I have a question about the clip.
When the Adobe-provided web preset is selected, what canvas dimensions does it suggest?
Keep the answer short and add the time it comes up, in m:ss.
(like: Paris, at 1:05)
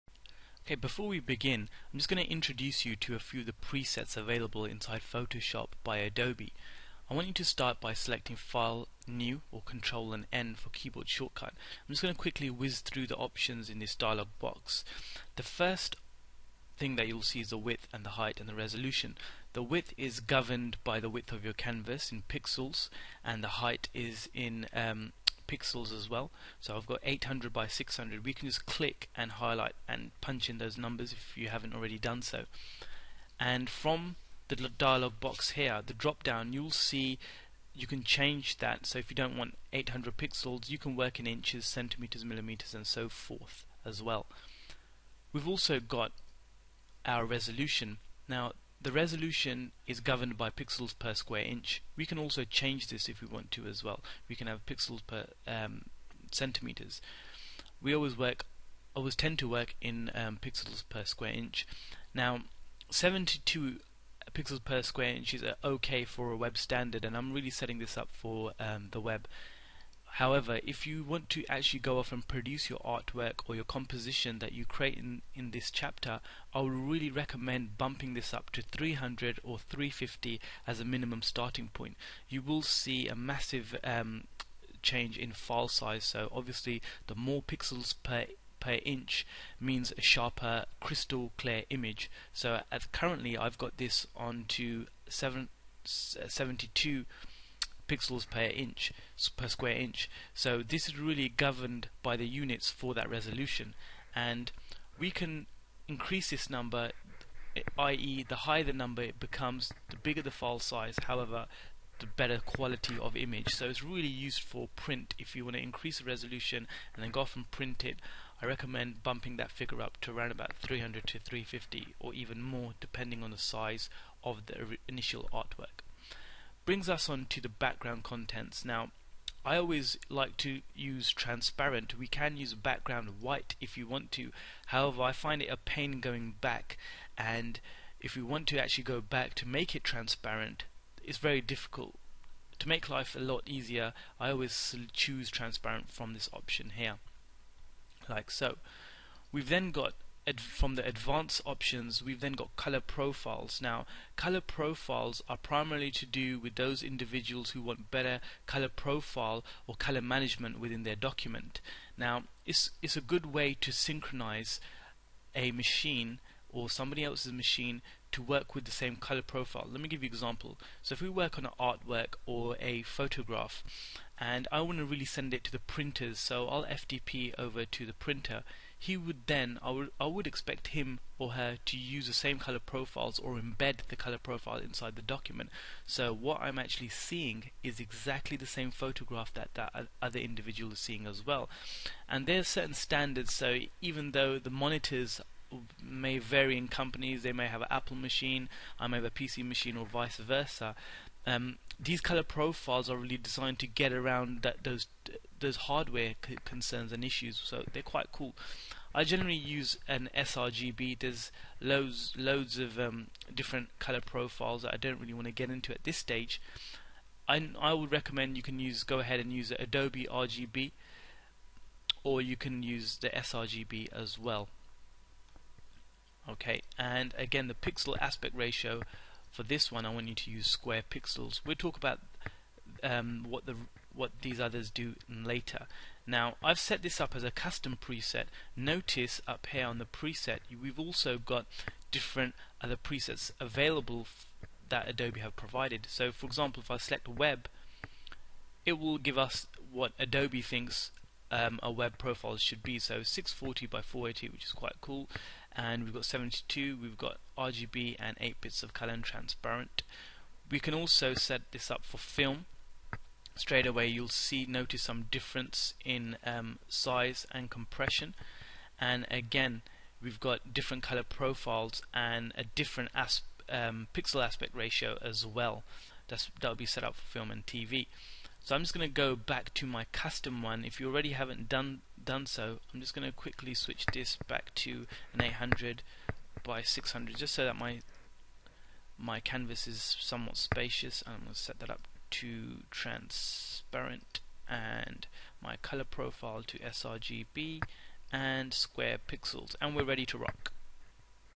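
640 by 480, at 4:13.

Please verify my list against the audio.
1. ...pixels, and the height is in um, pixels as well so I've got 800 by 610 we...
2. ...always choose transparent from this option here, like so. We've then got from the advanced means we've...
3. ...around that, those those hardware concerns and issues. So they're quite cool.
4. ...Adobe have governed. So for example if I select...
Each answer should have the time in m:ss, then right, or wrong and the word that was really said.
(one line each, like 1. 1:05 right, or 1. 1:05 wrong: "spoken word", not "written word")
1. 0:22 wrong: "600", not "610"
2. 2:24 wrong: "options", not "means"
3. 3:23 right
4. 4:04 wrong: "provided", not "governed".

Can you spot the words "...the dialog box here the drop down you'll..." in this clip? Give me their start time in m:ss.
0:34.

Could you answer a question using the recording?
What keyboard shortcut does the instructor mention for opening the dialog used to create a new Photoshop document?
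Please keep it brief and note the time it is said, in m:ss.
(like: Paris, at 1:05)
Control and N, at 0:09.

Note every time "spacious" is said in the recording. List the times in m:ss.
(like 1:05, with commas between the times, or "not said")
4:50.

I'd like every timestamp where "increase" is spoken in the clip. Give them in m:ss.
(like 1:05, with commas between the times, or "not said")
1:45, 1:55.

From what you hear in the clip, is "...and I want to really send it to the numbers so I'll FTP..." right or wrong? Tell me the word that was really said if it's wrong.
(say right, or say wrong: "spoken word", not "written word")
wrong: "printers", not "numbers".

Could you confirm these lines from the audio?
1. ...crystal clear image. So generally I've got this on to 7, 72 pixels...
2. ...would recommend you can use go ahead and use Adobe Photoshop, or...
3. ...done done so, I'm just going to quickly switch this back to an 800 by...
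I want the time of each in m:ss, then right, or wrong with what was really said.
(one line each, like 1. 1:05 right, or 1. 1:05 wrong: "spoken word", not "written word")
1. 1:30 wrong: "currently", not "generally"
2. 3:37 wrong: "RGB", not "Photoshop"
3. 4:41 right.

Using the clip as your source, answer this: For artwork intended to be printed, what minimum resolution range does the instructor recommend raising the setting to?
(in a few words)
300 or 350.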